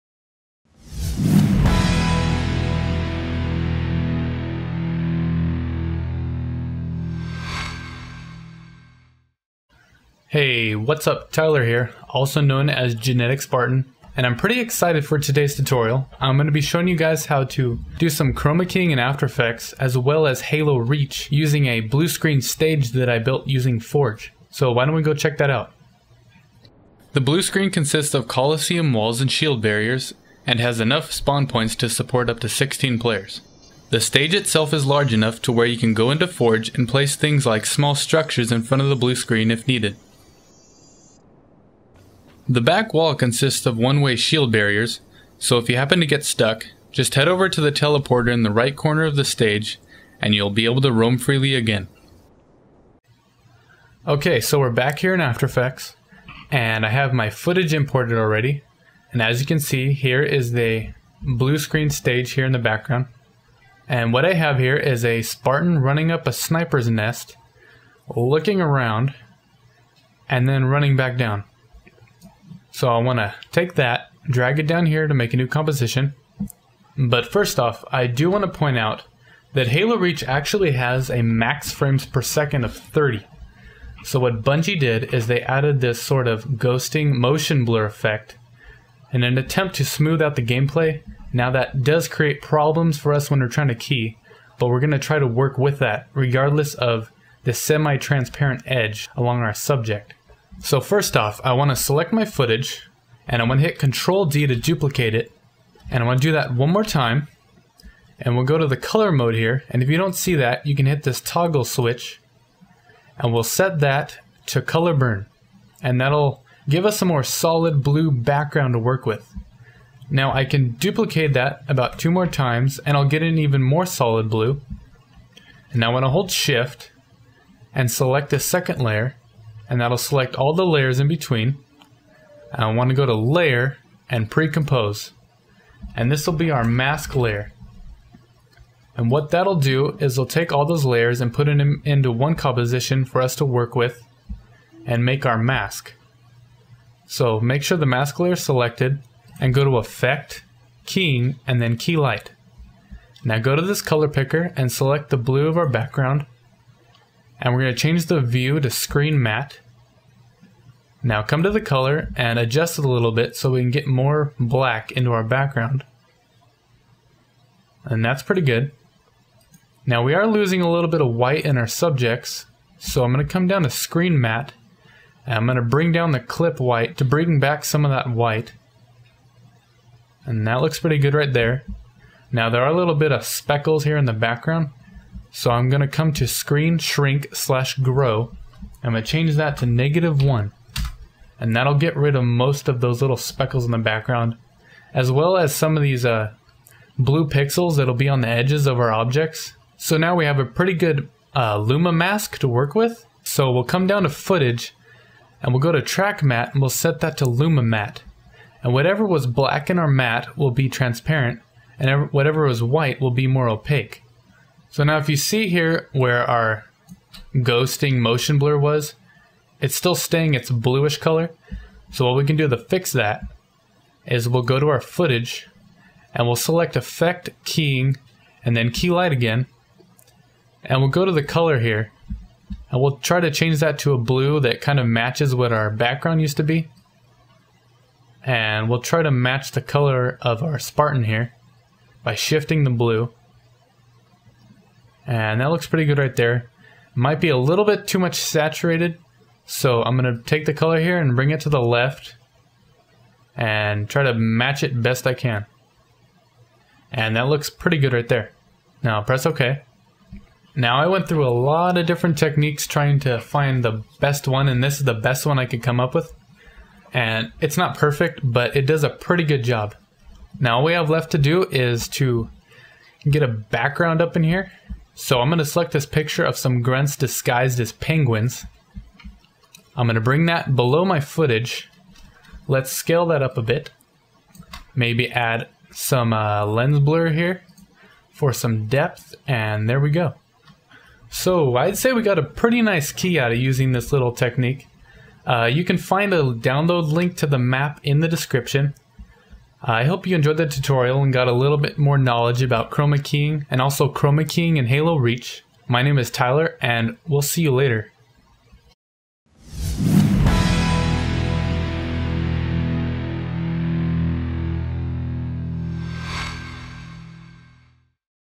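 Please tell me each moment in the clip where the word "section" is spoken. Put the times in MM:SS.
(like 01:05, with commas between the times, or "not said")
not said.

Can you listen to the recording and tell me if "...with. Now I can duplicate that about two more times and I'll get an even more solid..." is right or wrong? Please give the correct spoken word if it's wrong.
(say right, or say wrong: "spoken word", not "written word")
right.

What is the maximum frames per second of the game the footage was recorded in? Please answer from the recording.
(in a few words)
30.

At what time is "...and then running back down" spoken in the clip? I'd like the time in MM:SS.
01:10.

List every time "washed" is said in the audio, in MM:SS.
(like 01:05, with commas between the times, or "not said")
not said.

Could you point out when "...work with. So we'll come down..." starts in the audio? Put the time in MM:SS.
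03:22.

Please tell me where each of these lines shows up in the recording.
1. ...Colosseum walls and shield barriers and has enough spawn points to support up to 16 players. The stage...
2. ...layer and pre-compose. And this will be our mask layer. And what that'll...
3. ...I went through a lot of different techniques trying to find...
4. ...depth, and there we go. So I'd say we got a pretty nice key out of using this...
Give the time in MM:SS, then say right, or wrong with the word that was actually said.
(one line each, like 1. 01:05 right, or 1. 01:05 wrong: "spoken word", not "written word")
1. 00:28 right
2. 02:13 right
3. 04:20 right
4. 04:48 right.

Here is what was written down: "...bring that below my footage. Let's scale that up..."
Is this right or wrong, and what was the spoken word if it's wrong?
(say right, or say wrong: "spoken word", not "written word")
right.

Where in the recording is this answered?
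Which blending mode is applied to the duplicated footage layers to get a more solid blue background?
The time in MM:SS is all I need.
01:54.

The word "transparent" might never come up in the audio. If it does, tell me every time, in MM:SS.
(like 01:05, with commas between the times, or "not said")
01:37, 03:30.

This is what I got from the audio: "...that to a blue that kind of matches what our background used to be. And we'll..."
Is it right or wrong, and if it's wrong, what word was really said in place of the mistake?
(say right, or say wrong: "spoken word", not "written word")
right.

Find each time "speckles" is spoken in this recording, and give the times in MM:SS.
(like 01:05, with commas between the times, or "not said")
03:03, 03:13.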